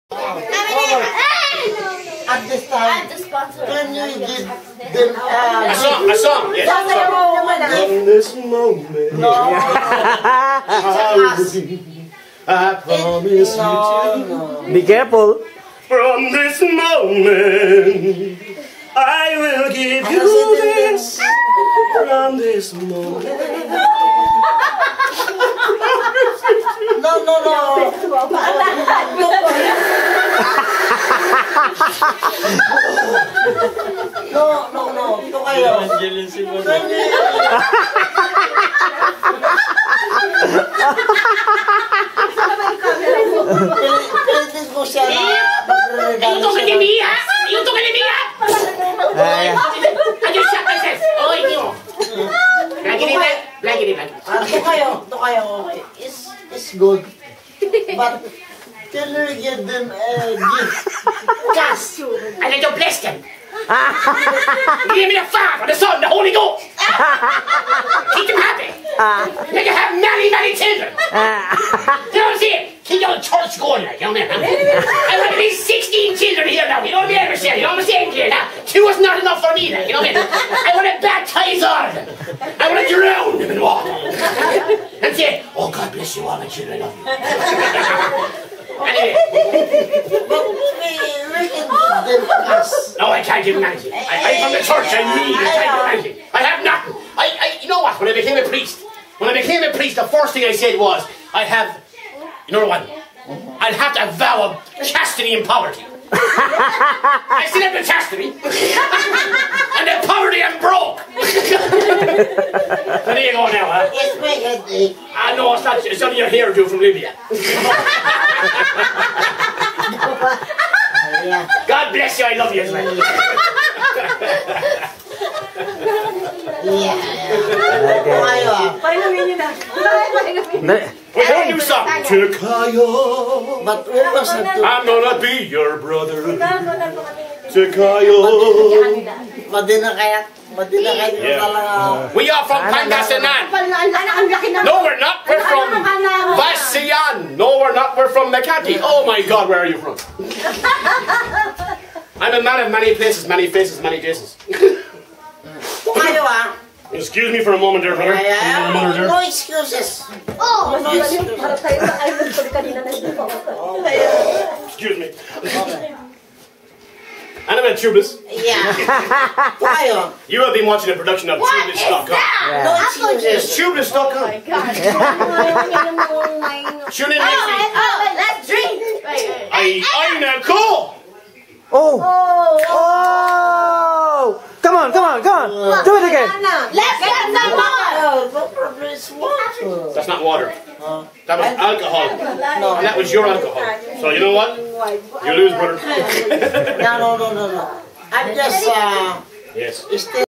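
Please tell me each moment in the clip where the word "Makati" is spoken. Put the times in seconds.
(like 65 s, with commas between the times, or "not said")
148 s.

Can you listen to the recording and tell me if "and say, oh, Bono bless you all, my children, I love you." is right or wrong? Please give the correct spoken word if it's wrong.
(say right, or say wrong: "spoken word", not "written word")
wrong: "God", not "Bono".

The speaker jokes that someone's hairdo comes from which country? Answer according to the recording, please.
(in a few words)
Libya.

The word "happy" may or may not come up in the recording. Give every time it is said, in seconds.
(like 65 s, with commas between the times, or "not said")
68 s.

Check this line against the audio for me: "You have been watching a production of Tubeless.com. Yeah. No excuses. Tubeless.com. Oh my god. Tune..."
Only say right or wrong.
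right.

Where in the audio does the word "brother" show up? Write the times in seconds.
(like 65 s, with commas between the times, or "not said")
135 s, 157 s, 195 s.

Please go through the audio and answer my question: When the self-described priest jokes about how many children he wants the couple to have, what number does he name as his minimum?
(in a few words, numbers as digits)
16.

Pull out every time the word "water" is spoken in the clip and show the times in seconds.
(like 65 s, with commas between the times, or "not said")
83 s, 190 s.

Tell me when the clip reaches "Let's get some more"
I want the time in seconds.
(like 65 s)
186 s.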